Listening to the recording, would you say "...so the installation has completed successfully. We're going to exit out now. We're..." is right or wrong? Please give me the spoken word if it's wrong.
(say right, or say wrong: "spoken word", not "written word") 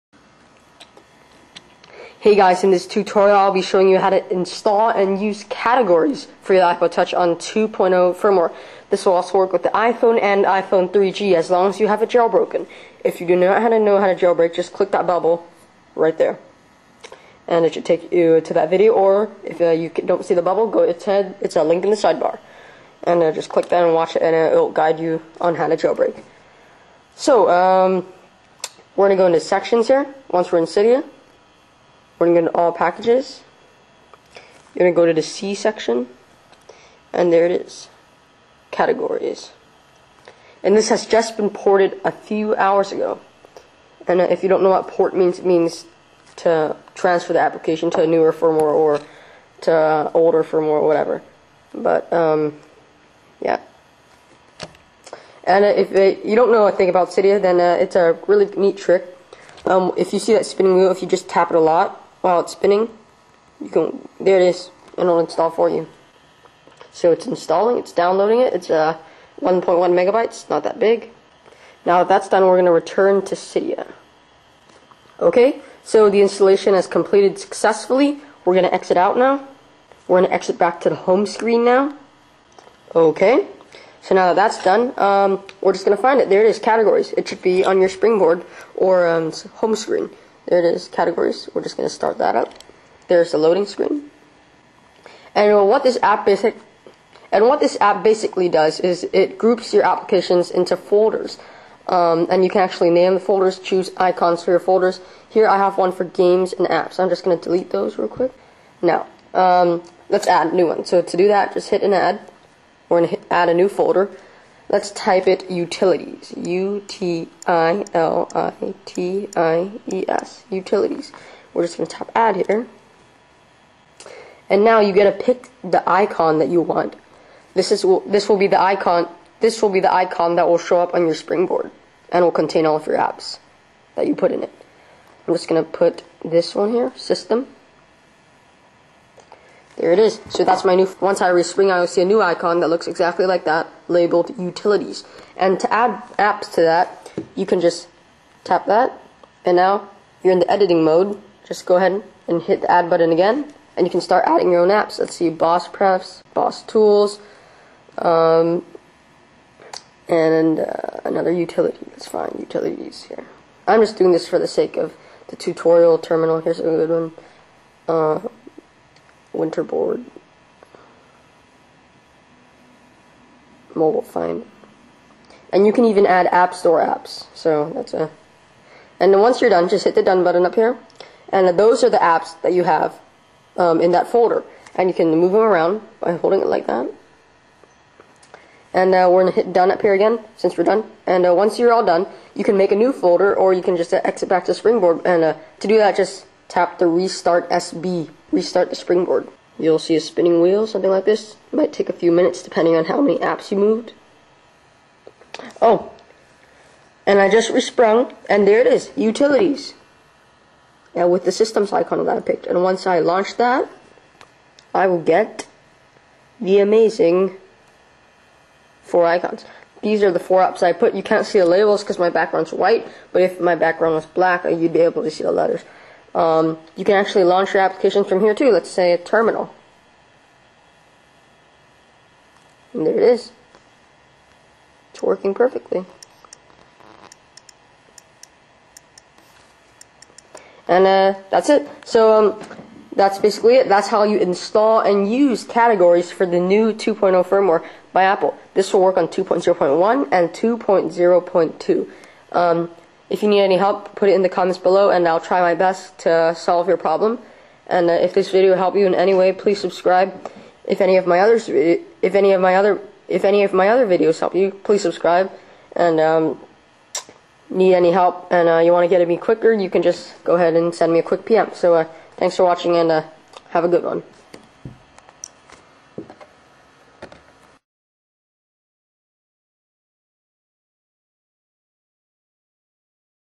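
right.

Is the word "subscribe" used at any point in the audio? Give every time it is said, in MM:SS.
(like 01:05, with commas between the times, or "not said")
04:19, 04:24.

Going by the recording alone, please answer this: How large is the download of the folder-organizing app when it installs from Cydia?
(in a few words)
1.1 megabytes.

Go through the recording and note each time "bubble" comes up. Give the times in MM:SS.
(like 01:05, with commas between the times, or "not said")
00:15, 00:20.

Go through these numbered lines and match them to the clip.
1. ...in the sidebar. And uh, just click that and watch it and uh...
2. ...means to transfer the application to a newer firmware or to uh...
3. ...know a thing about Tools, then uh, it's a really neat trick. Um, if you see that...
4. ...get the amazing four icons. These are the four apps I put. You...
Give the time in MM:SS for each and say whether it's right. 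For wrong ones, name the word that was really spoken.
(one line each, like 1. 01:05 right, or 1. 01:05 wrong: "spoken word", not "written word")
1. 00:21 right
2. 00:45 right
3. 00:56 wrong: "Cydia", not "Tools"
4. 03:35 right.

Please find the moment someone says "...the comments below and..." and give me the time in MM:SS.
04:14.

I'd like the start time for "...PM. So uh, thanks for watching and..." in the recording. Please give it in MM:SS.
04:31.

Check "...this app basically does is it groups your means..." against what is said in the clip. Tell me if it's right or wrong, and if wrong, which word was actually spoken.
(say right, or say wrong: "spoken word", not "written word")
wrong: "applications", not "means".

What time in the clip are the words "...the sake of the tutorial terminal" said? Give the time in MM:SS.
02:44.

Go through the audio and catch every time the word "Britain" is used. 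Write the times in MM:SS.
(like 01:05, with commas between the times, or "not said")
not said.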